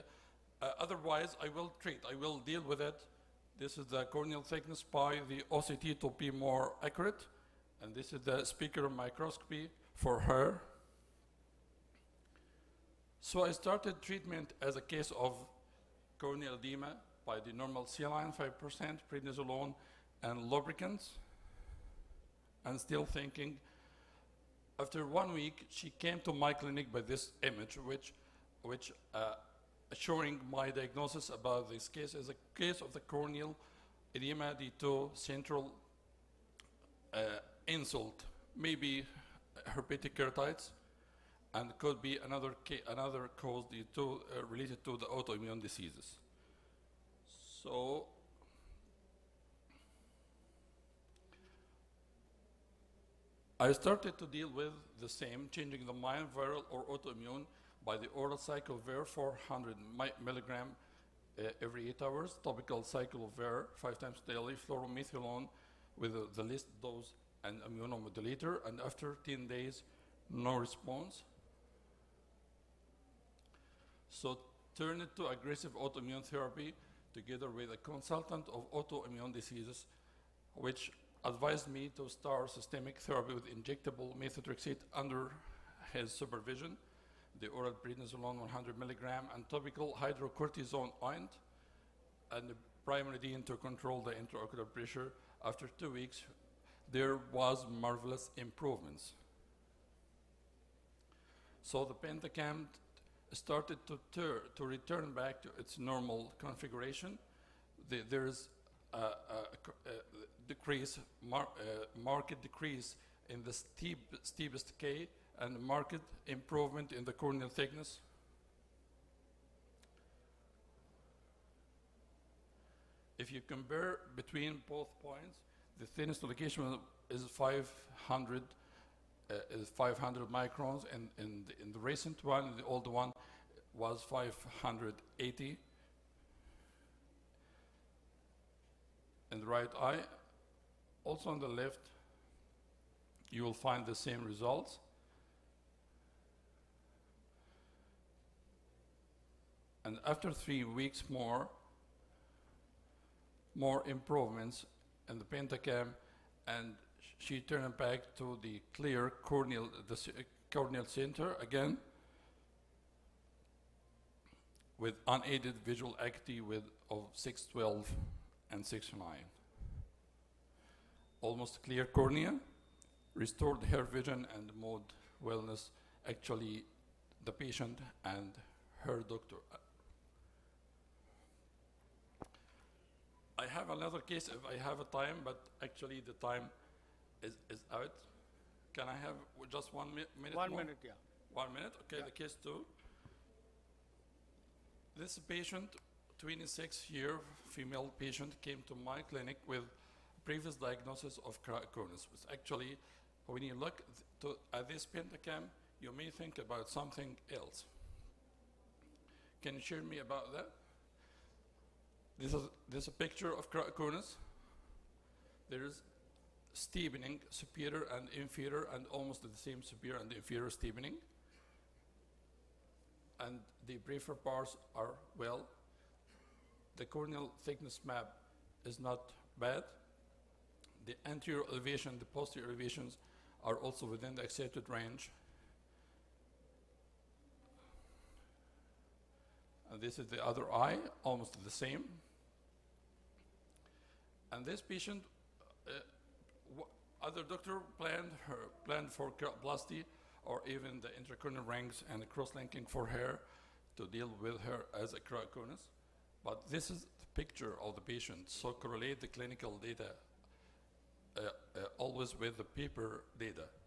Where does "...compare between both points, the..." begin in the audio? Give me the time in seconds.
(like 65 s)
123 s.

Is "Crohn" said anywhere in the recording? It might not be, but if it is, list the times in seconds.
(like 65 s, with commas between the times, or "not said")
201 s, 213 s.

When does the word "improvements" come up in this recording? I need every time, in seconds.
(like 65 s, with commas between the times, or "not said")
98 s, 116 s, 153 s.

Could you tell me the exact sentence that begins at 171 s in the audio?
Almost clear cornea, restored her vision and mood, wellness.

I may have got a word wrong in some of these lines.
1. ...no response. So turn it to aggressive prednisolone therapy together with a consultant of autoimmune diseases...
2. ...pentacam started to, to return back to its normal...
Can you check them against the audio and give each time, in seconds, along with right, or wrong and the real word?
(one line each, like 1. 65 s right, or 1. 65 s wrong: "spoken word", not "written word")
1. 70 s wrong: "autoimmune", not "prednisolone"
2. 102 s right.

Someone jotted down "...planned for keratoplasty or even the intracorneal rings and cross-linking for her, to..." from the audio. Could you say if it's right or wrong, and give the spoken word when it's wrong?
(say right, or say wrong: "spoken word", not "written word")
right.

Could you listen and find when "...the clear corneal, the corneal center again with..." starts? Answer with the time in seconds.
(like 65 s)
158 s.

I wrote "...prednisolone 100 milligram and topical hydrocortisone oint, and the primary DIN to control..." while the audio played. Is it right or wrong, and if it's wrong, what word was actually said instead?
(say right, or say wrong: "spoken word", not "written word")
right.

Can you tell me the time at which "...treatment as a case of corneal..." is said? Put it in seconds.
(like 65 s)
14 s.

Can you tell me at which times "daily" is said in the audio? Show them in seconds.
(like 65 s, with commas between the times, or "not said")
64 s.